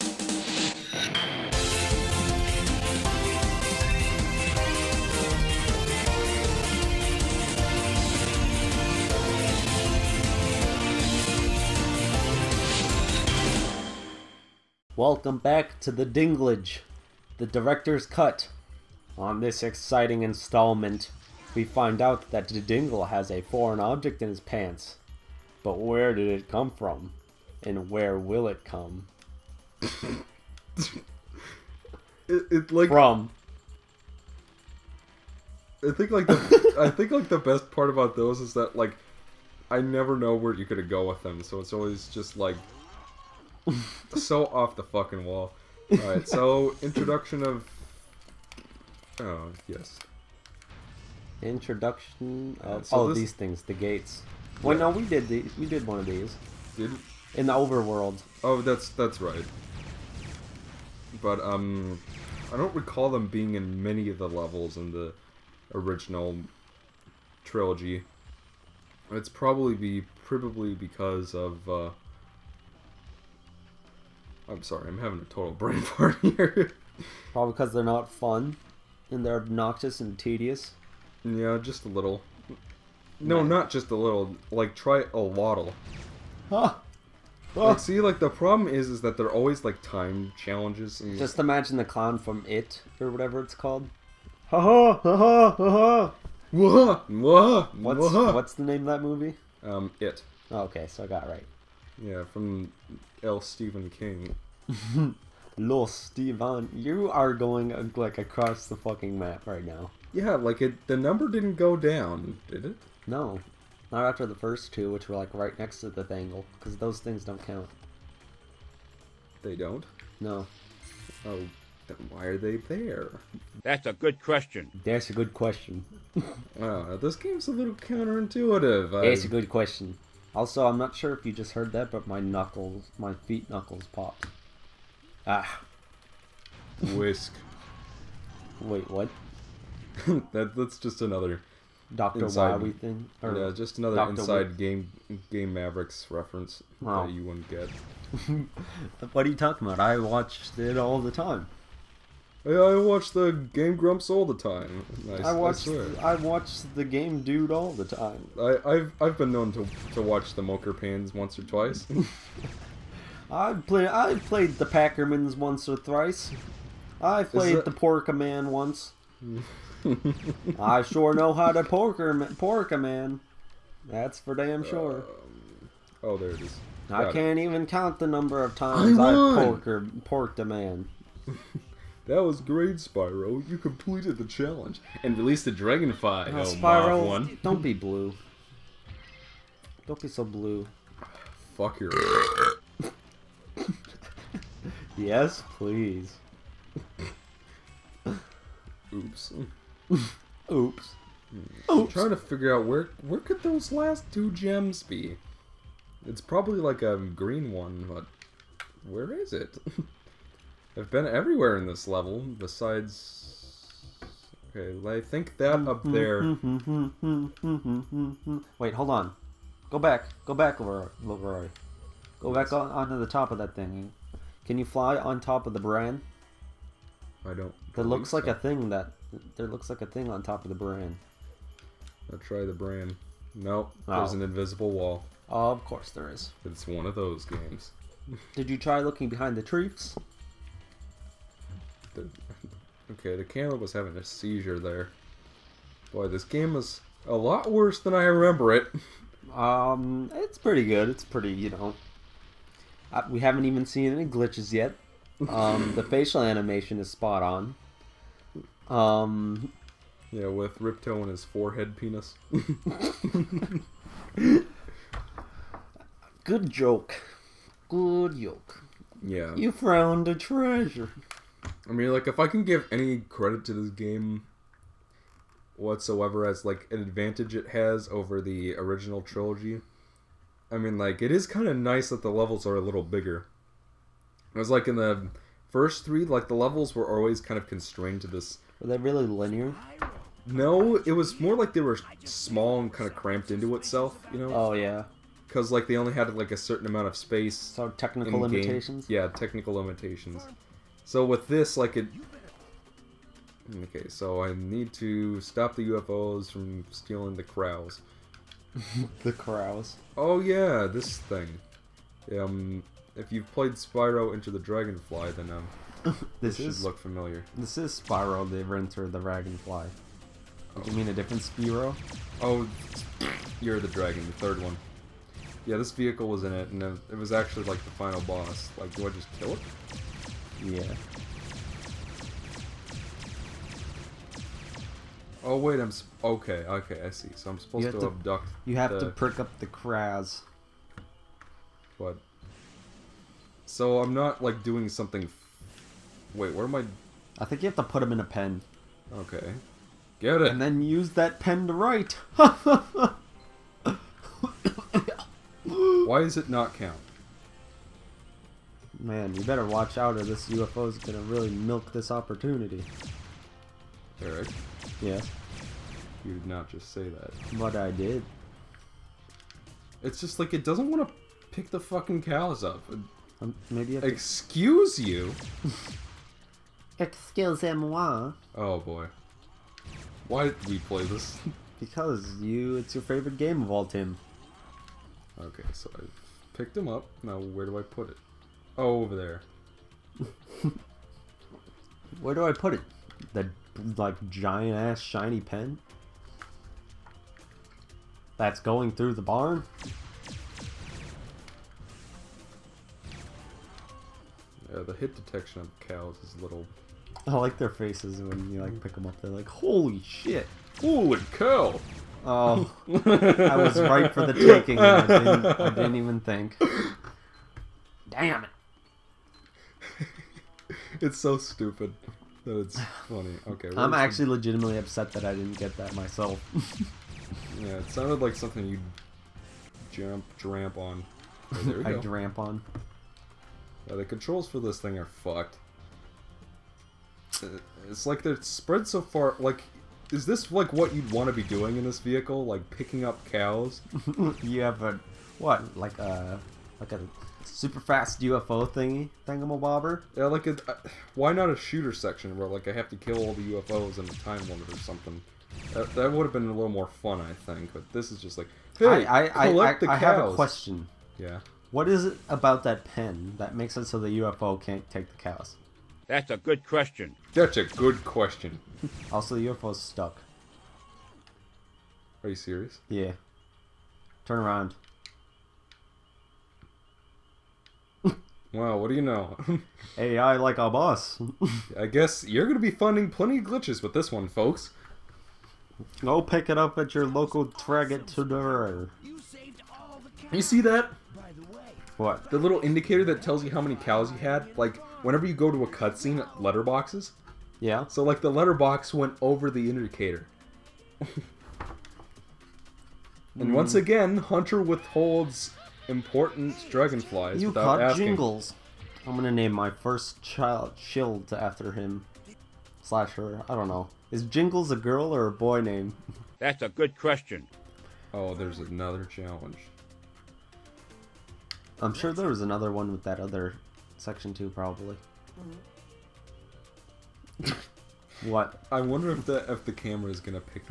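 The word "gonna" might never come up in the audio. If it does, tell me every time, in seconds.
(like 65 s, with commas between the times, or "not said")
40 s, 508 s, 529 s.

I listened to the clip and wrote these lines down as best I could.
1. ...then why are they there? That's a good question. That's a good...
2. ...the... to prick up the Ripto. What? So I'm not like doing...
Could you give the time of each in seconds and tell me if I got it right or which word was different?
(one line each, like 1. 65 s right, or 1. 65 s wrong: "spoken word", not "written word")
1. 121 s right
2. 338 s wrong: "Kraz", not "Ripto".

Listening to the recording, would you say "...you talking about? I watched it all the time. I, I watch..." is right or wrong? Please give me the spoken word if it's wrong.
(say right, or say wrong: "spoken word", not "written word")
right.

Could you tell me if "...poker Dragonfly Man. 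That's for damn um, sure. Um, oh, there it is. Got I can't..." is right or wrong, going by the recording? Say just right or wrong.
wrong.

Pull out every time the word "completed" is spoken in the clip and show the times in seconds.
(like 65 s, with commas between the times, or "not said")
183 s.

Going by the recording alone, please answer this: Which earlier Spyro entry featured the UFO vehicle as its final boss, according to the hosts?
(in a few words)
Year of the Dragon.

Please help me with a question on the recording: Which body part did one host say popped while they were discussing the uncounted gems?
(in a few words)
feet knuckles.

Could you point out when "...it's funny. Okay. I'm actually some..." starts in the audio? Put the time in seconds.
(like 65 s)
422 s.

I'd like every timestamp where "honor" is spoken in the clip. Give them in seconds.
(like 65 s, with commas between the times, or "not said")
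not said.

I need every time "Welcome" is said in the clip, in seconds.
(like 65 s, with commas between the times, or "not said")
15 s.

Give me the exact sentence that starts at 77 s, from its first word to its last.
Probably because they're not fun, and they're obnoxious and tedious.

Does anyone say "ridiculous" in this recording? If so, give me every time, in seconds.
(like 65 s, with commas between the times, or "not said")
not said.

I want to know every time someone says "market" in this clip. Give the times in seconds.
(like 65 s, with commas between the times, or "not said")
not said.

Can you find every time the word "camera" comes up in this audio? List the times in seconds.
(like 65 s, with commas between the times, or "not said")
243 s, 529 s.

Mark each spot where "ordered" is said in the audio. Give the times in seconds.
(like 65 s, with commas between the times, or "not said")
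not said.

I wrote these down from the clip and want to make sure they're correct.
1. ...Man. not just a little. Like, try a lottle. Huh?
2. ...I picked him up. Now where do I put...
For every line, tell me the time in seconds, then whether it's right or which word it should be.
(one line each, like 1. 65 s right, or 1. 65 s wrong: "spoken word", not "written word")
1. 83 s right
2. 385 s right.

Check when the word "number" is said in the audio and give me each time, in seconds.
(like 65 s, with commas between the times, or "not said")
110 s, 178 s.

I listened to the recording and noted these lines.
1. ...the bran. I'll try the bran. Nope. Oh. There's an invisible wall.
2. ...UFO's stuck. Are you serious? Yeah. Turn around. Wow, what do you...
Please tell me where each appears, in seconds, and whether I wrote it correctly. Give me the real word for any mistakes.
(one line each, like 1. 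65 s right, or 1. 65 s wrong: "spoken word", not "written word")
1. 230 s right
2. 469 s right.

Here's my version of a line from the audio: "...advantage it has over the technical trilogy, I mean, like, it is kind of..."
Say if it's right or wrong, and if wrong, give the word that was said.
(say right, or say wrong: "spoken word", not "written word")
wrong: "original", not "technical".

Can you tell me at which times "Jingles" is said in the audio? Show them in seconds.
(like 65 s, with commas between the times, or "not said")
507 s, 514 s.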